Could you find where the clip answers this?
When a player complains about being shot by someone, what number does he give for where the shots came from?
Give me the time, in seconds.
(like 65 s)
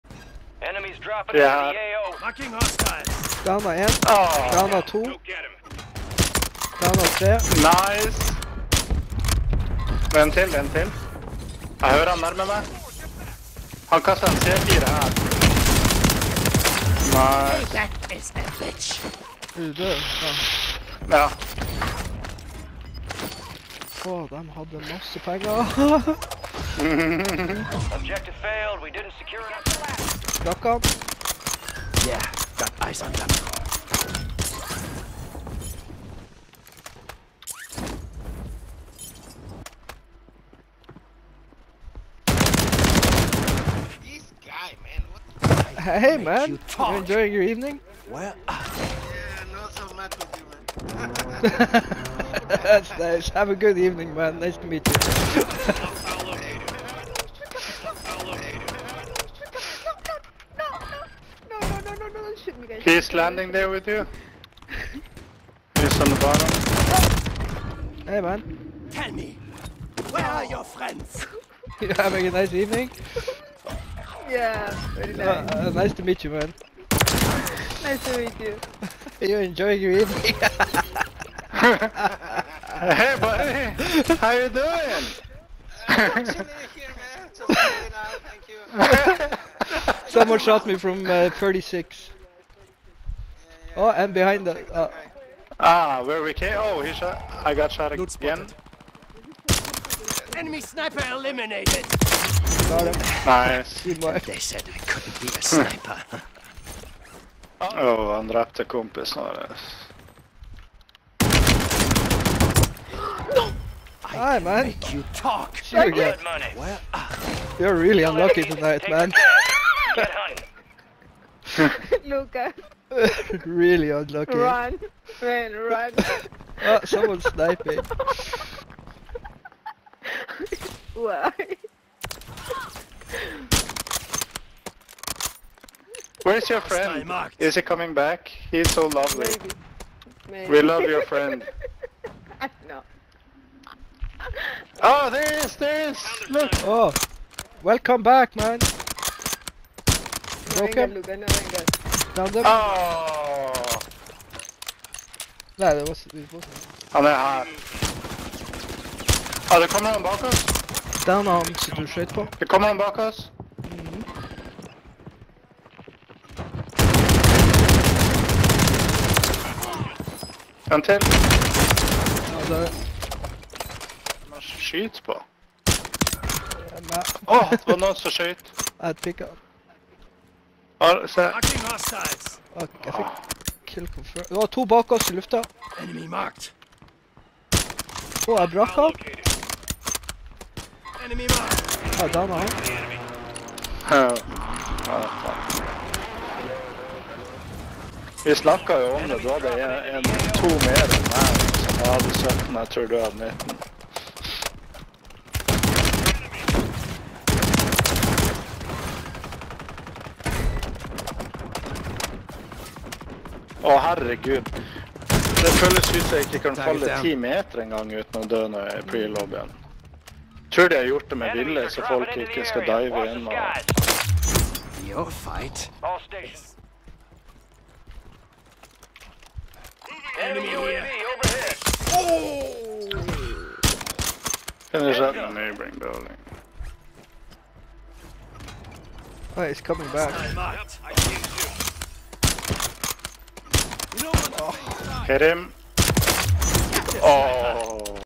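91 s.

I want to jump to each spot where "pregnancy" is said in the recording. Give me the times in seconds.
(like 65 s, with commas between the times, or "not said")
not said.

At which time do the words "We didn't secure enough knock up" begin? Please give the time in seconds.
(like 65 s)
28 s.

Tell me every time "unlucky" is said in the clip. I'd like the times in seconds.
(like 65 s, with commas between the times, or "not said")
118 s, 123 s.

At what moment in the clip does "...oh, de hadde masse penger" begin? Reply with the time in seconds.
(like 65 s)
24 s.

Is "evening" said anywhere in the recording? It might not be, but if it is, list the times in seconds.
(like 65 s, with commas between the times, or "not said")
47 s, 53 s, 72 s, 79 s.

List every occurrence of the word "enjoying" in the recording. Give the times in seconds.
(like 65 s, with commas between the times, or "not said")
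46 s, 79 s.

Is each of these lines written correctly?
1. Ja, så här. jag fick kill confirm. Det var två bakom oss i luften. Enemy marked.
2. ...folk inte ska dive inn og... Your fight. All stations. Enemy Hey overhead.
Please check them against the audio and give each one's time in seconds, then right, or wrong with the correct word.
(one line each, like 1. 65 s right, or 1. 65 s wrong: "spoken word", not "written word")
1. 180 s right
2. 221 s wrong: "UAV", not "Hey".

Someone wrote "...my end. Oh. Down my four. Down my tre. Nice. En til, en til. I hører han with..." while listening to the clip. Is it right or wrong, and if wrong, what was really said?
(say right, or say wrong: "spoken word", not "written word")
wrong: "two", not "four".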